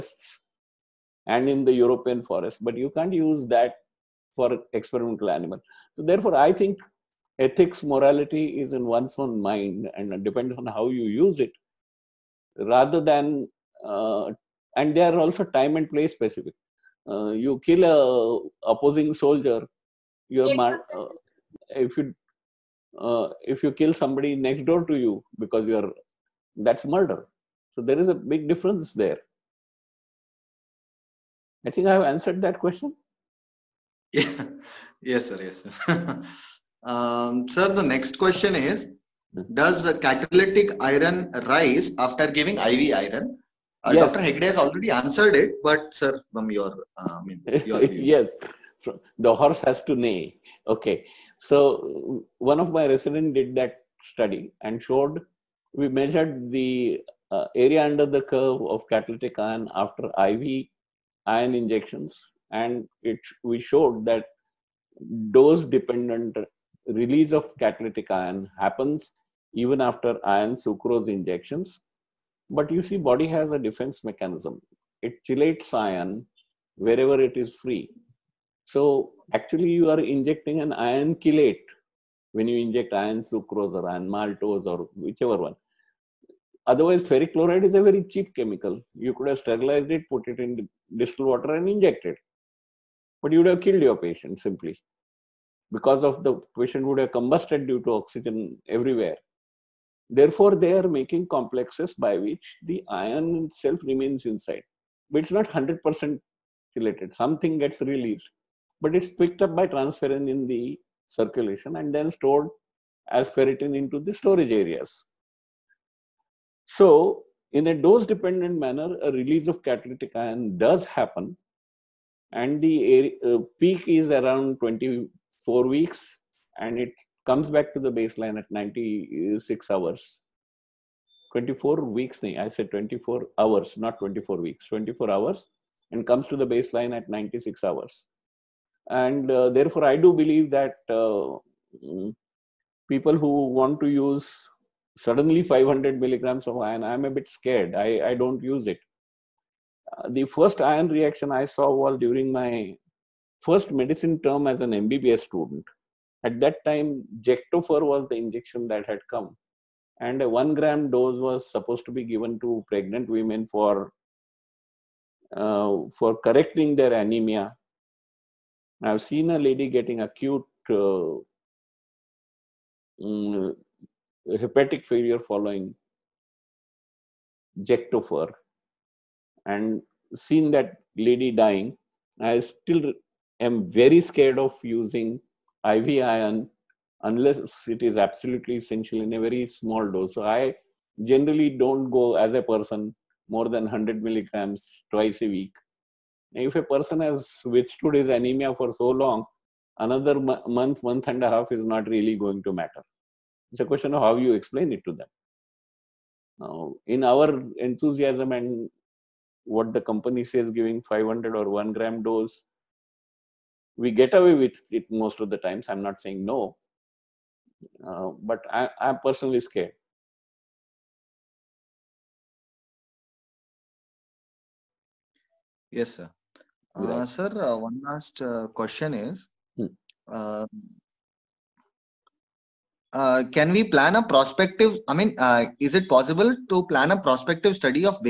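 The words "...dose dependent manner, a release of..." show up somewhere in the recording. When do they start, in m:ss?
1:57.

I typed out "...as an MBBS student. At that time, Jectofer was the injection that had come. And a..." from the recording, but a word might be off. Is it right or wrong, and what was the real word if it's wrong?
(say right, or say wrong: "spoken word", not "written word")
right.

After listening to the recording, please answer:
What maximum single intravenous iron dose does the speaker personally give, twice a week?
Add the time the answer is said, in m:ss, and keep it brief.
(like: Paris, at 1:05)
100 milligrams, at 3:13.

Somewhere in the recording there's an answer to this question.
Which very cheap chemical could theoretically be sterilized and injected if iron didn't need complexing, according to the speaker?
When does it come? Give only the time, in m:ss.
1:27.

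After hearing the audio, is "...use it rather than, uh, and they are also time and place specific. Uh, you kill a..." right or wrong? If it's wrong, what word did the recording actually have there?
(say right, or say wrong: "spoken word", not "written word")
right.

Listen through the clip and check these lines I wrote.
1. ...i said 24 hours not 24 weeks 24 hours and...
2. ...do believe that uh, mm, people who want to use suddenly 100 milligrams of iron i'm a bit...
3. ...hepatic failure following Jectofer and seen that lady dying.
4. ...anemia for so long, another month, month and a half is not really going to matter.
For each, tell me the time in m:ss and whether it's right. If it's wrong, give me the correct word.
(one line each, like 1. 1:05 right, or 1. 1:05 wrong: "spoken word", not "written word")
1. 2:12 right
2. 2:19 wrong: "500", not "100"
3. 2:54 right
4. 3:18 right.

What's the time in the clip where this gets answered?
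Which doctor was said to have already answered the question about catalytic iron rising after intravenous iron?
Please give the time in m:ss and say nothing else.
0:44.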